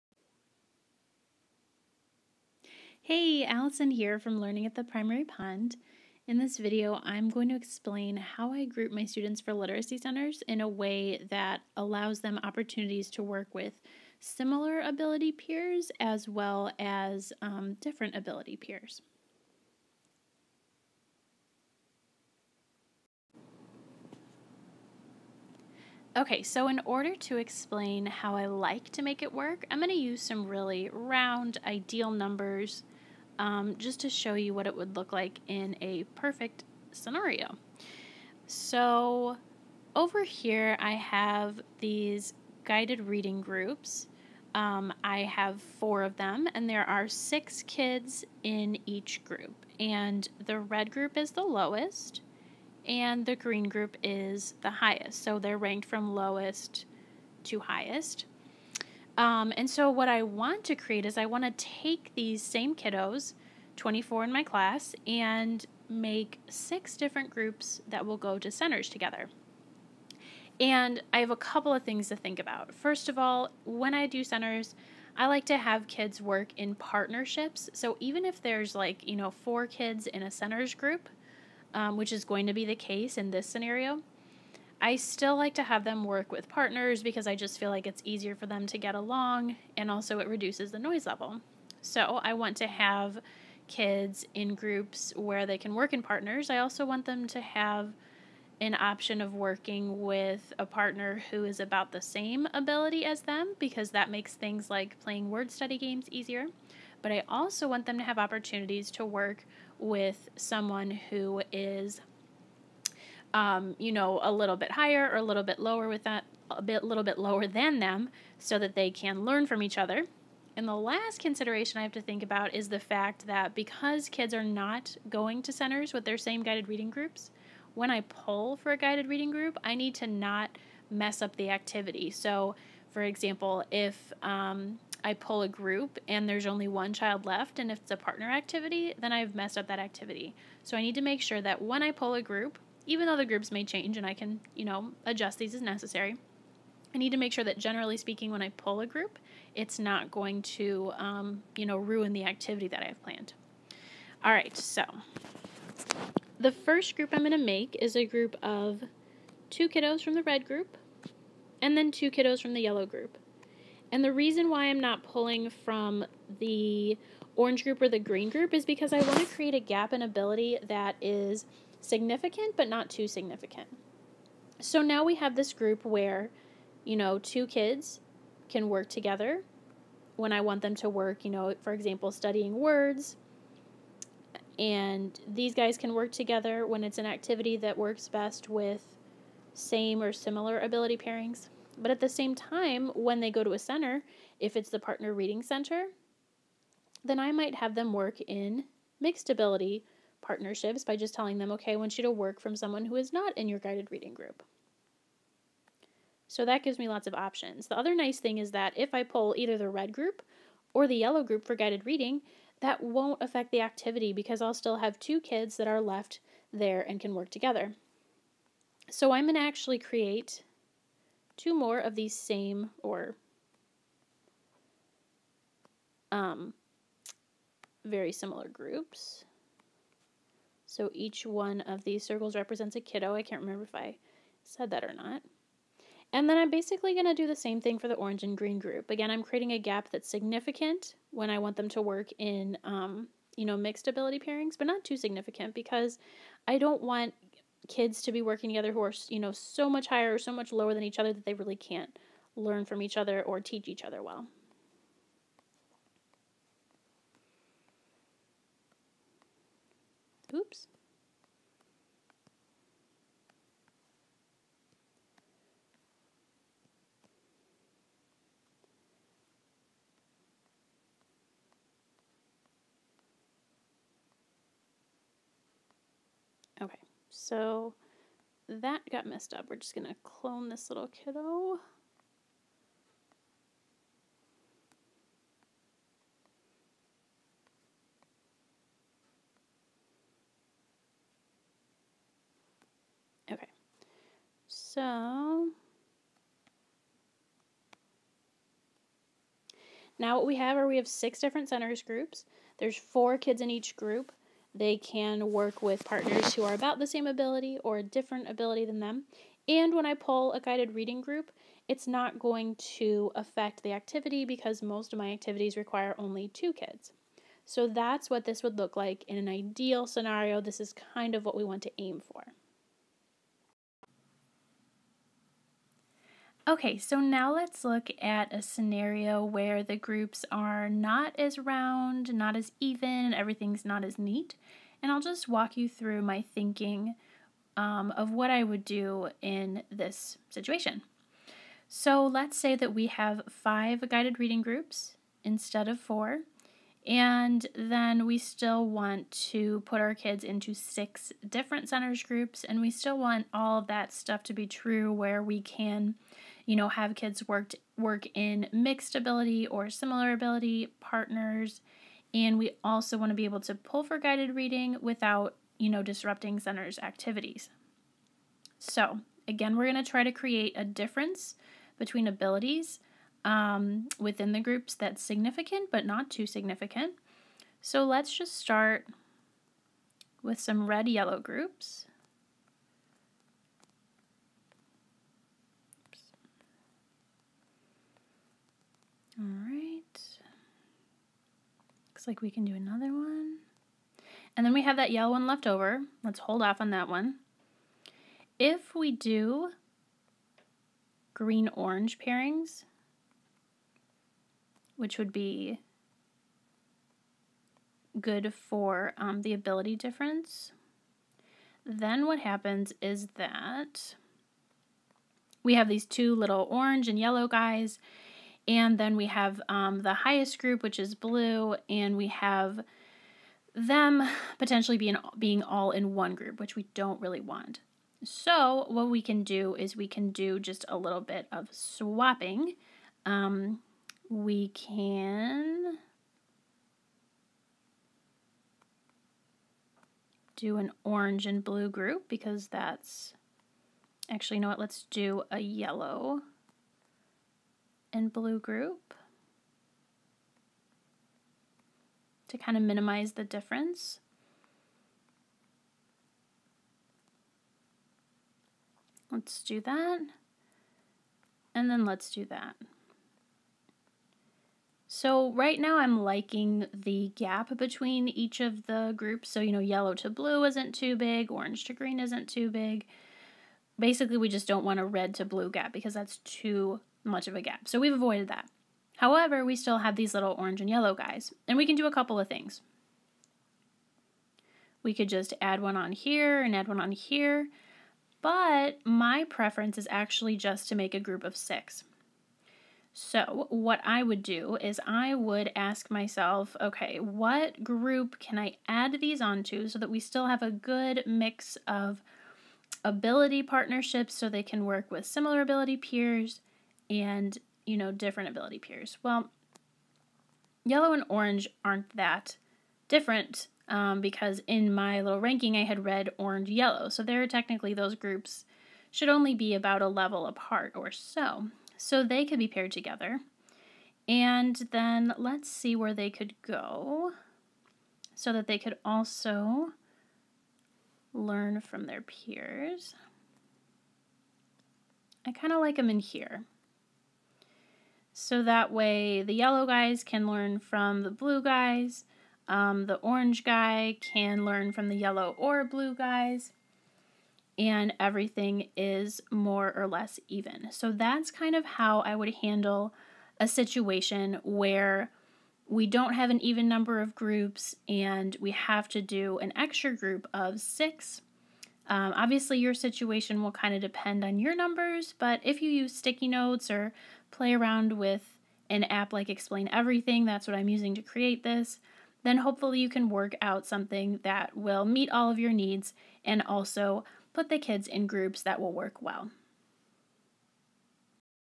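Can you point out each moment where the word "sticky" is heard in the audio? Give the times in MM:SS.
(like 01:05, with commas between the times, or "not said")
09:25.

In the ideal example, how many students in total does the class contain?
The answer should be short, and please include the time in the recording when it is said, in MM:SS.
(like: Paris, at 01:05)
24, at 01:03.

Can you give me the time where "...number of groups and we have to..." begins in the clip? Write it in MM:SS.
09:16.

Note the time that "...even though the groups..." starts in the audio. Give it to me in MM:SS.
02:22.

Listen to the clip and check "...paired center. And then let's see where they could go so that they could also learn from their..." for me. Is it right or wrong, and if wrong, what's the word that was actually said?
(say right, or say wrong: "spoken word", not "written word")
wrong: "together", not "center".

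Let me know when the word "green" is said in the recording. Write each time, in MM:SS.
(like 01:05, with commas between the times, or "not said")
00:53, 02:47, 03:58, 06:41, 07:51.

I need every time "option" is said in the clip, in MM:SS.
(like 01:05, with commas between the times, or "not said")
01:38, 03:27.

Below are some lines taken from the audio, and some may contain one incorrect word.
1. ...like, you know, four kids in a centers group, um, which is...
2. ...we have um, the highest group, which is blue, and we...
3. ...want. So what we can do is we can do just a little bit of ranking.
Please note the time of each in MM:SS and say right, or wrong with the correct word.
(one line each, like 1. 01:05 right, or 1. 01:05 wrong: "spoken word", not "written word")
1. 01:18 right
2. 06:58 right
3. 07:07 wrong: "swapping", not "ranking".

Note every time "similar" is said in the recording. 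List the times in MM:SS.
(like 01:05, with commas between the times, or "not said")
00:14, 03:10, 03:48, 05:59, 08:25.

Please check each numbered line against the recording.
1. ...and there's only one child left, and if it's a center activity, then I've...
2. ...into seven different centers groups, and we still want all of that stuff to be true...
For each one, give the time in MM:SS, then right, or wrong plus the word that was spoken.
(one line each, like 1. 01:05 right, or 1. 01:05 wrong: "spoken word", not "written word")
1. 02:16 wrong: "partner", not "center"
2. 05:50 wrong: "six", not "seven".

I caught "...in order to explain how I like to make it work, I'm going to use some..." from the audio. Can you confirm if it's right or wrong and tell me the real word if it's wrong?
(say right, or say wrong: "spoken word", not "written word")
right.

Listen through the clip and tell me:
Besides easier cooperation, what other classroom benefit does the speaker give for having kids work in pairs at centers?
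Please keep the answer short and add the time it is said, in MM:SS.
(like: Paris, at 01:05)
Reduces the noise level, at 01:30.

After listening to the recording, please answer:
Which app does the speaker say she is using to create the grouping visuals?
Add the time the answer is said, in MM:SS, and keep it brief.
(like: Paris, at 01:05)
Explain Everything, at 09:29.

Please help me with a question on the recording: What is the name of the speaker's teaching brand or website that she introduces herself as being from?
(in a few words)
Learning at the Primary Pond.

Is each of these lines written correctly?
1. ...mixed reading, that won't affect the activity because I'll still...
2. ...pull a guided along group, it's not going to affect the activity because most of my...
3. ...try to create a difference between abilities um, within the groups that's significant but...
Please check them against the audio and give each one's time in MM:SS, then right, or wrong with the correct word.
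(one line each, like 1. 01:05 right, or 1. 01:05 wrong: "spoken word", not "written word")
1. 03:31 wrong: "guided", not "mixed"
2. 05:09 wrong: "reading", not "along"
3. 06:09 right.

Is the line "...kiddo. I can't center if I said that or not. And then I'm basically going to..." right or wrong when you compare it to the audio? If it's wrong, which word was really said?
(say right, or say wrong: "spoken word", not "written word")
wrong: "remember", not "center".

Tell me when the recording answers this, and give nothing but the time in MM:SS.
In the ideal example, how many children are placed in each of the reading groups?
00:47.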